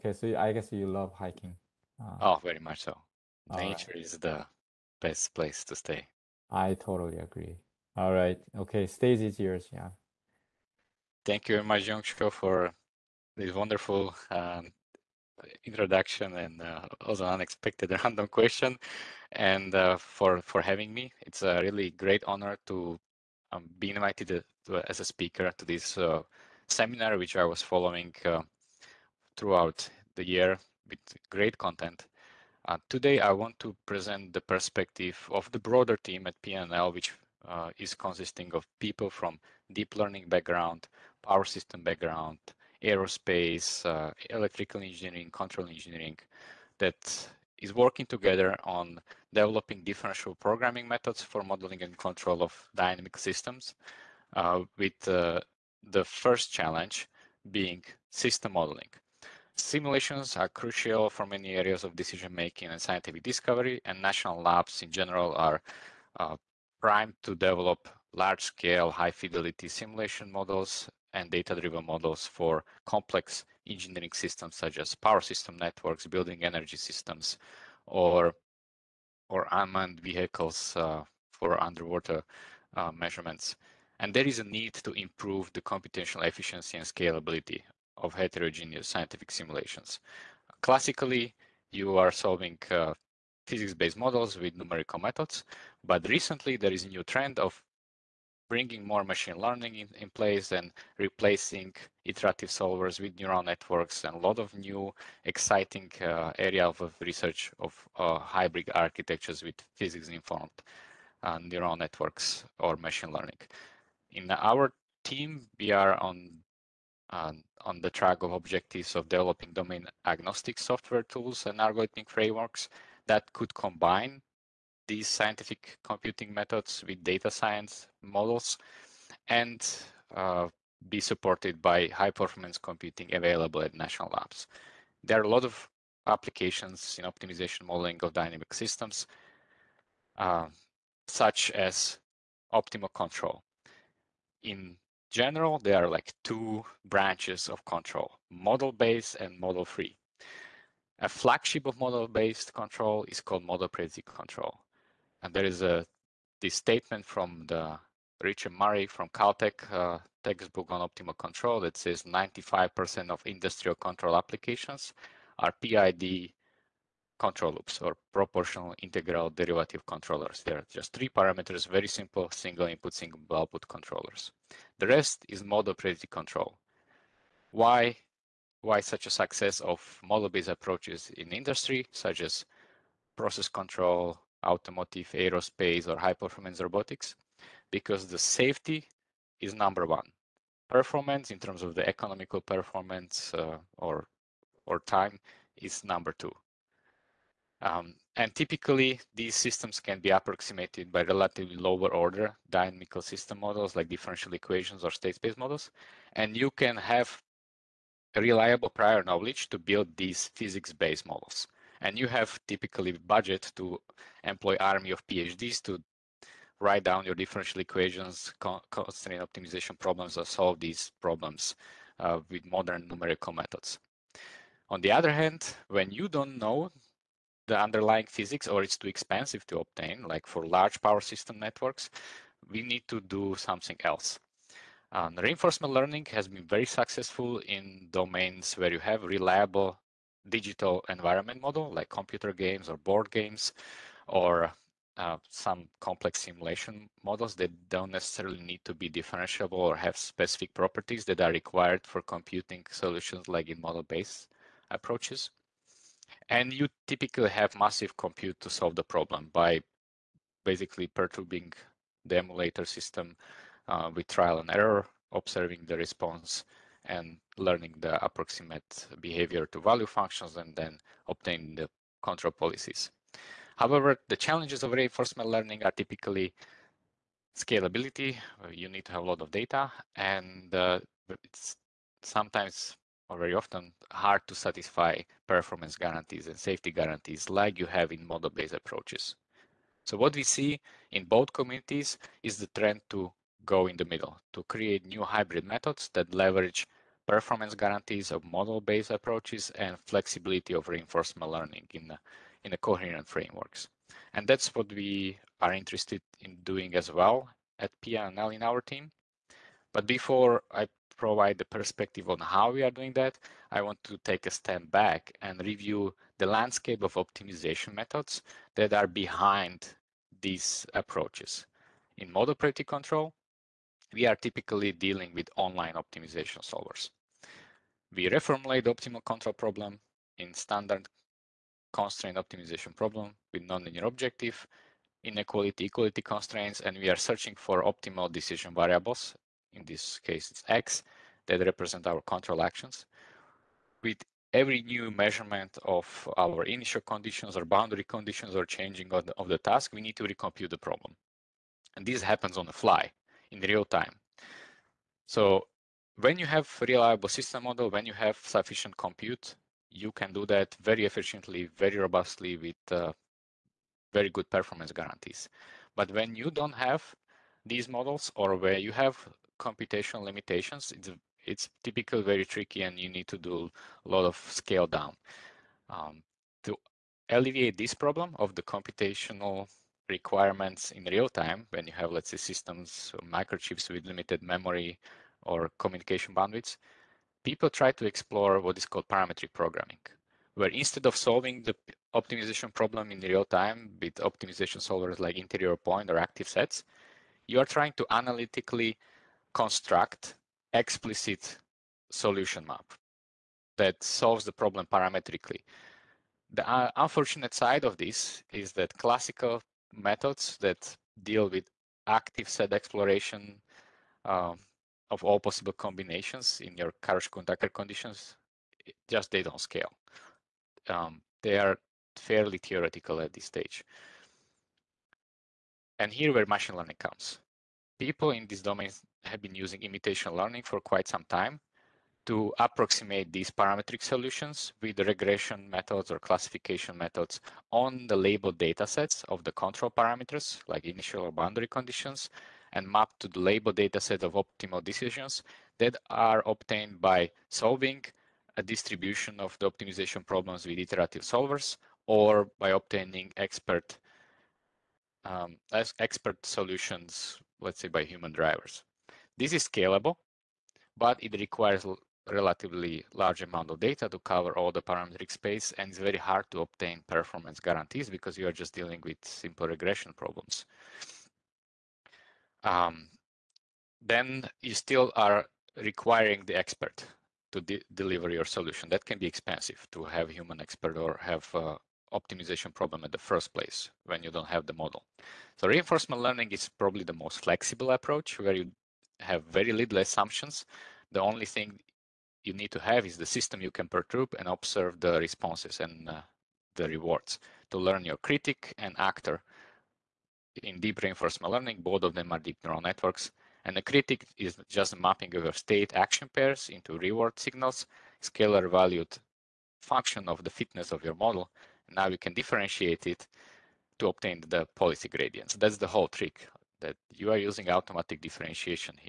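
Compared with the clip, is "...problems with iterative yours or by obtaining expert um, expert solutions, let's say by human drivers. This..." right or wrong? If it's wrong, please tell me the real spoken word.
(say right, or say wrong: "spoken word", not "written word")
wrong: "solvers", not "yours".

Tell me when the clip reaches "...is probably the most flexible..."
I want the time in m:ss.
8:06.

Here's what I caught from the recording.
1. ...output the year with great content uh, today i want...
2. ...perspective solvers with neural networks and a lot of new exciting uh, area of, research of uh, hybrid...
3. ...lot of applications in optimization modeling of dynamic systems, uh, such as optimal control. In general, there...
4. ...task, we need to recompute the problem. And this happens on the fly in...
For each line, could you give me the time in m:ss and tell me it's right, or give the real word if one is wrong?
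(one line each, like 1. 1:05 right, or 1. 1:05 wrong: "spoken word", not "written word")
1. 0:29 wrong: "throughout", not "output"
2. 1:42 wrong: "iterative", not "perspective"
3. 2:15 right
4. 5:49 right.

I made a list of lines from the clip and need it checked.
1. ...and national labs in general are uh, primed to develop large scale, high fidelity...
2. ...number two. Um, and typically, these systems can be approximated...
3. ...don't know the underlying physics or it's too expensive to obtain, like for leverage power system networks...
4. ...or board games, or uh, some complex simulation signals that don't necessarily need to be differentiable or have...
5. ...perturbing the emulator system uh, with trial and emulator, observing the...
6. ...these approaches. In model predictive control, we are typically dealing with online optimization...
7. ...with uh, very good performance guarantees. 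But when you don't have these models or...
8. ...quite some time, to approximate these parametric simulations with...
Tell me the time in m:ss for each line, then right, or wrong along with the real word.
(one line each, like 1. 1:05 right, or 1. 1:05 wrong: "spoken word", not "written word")
1. 1:03 right
2. 3:15 right
3. 3:46 wrong: "large", not "leverage"
4. 4:02 wrong: "models", not "signals"
5. 4:20 wrong: "error", not "emulator"
6. 5:20 right
7. 6:02 right
8. 7:10 wrong: "solutions", not "simulations".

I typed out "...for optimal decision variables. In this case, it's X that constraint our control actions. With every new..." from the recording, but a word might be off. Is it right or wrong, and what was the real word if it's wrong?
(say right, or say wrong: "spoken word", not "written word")
wrong: "represent", not "constraint".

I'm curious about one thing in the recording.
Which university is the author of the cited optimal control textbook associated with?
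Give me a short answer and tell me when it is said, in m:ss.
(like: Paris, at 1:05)
Caltech, at 2:39.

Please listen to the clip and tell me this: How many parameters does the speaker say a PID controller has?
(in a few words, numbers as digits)
3.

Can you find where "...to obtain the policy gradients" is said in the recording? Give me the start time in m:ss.
8:33.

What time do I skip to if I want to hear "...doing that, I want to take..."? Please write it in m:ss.
5:12.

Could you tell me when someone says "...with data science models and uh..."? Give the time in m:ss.
2:06.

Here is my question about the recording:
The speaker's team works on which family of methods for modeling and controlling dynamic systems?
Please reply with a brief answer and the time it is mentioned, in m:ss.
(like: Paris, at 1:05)
differential programming, at 0:49.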